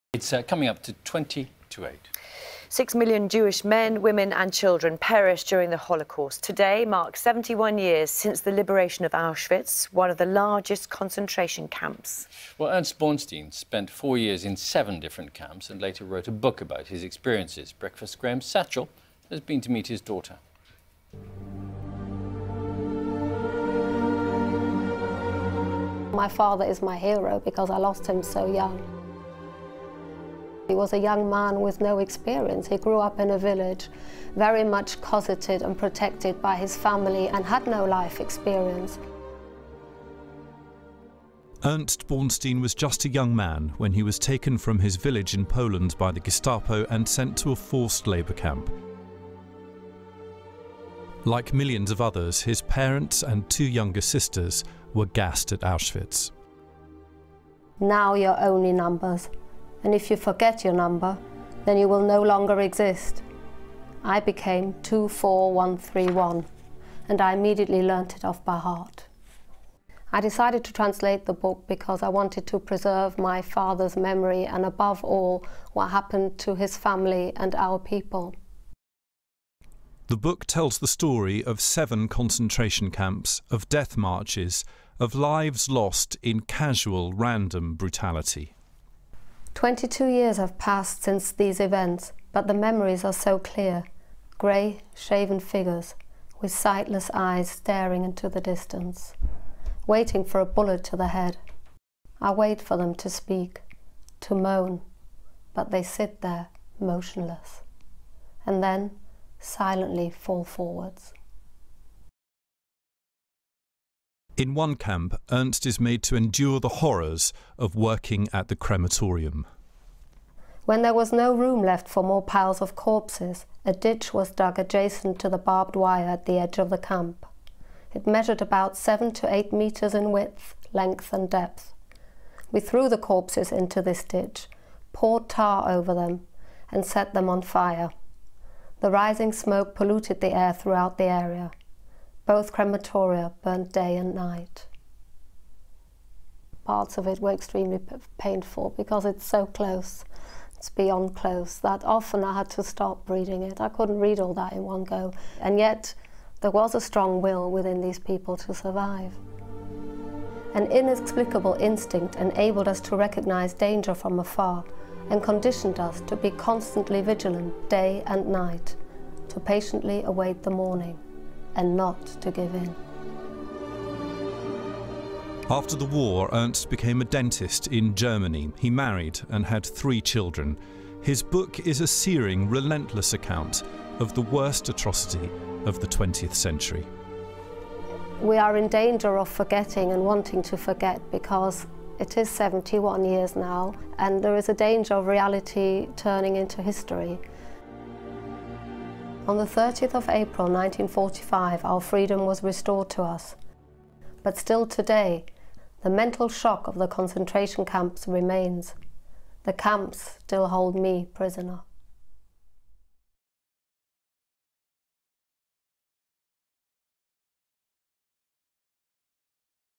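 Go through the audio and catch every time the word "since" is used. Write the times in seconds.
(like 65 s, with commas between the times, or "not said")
8 s, 91 s.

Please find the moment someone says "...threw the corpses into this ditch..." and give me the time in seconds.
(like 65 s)
132 s.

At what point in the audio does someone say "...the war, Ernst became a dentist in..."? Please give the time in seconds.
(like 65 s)
175 s.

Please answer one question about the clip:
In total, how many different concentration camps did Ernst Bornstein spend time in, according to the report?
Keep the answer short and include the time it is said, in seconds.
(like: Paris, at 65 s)
7, at 14 s.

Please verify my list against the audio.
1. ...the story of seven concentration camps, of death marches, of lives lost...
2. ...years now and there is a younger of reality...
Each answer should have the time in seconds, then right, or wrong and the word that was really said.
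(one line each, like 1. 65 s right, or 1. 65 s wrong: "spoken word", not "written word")
1. 80 s right
2. 193 s wrong: "danger", not "younger".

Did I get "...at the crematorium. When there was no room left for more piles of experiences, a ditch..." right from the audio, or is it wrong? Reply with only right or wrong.
wrong.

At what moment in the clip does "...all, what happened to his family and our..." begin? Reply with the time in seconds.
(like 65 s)
75 s.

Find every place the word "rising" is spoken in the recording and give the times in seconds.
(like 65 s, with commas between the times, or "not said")
138 s.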